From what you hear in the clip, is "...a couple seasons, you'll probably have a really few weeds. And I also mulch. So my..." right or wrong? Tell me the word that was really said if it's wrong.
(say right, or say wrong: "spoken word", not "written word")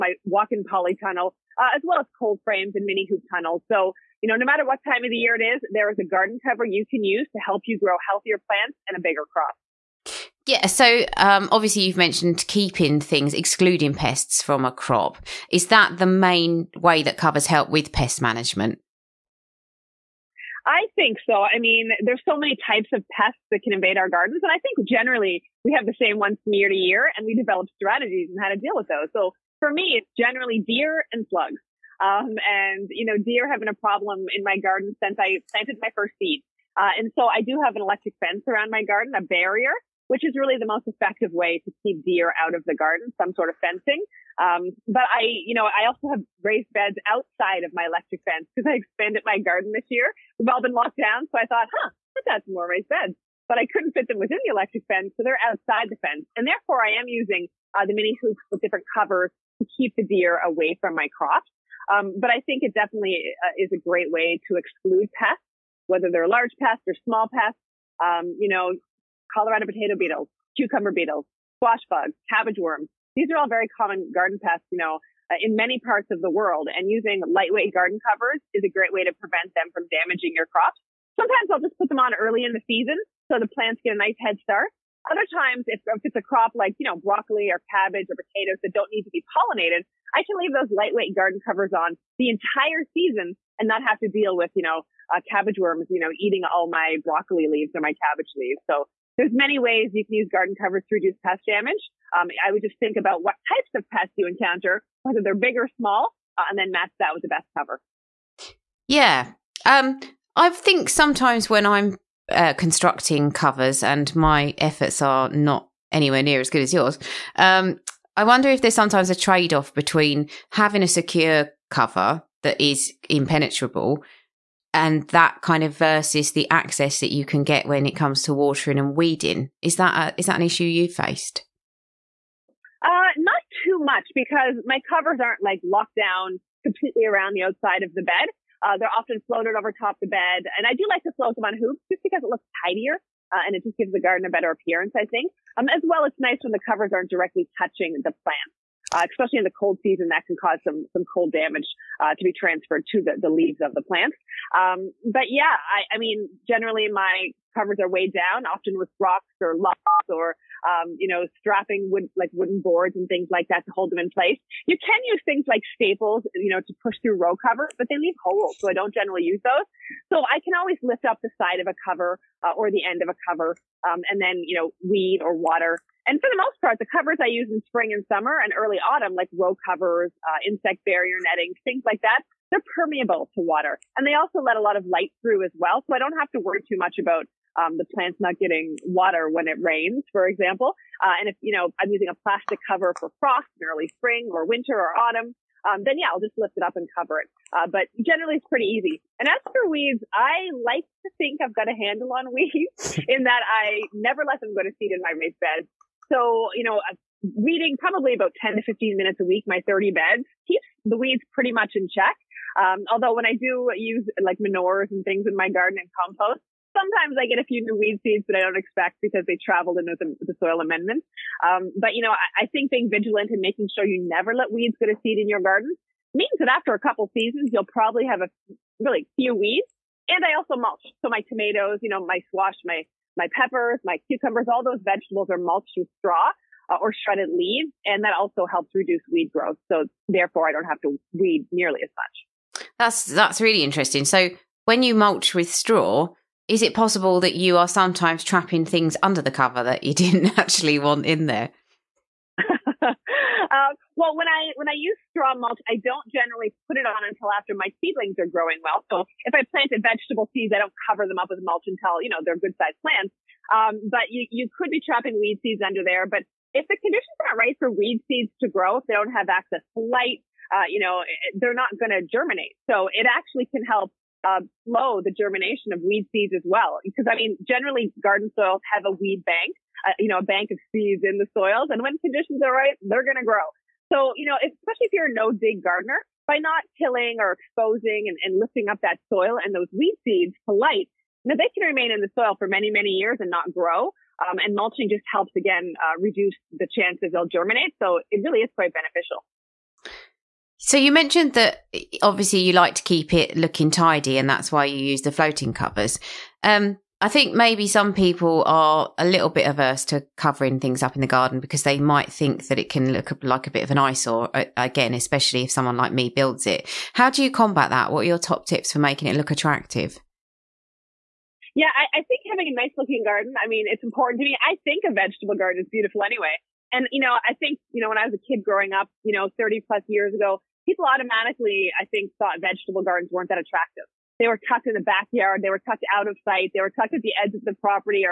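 right.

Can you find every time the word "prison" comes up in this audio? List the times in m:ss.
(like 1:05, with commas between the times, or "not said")
not said.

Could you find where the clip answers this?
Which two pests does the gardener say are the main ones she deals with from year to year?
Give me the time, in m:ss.
0:30.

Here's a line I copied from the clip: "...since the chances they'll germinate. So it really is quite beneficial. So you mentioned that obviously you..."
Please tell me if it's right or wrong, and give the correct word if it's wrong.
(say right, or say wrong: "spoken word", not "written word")
wrong: "reduce", not "since".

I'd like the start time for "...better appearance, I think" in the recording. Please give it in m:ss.
2:24.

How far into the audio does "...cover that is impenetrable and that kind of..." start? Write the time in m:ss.
2:01.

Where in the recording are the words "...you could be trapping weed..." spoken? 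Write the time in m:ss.
4:24.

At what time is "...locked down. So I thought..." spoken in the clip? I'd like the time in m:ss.
0:50.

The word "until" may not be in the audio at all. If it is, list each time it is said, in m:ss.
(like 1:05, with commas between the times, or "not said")
4:17, 4:21.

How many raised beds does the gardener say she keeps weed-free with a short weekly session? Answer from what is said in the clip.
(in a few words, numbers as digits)
30.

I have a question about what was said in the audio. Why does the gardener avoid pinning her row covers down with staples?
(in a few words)
they leave holes.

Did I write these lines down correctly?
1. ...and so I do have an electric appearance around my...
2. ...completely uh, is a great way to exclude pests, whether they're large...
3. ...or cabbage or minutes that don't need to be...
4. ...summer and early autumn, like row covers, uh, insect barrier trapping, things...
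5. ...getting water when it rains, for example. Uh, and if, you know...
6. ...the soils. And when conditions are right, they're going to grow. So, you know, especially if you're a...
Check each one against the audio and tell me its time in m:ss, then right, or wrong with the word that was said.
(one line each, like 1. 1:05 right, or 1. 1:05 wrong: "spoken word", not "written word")
1. 0:36 wrong: "fence", not "appearance"
2. 1:02 wrong: "definitely", not "completely"
3. 1:27 wrong: "potatoes", not "minutes"
4. 2:58 wrong: "netting", not "trapping"
5. 3:08 right
6. 4:41 right.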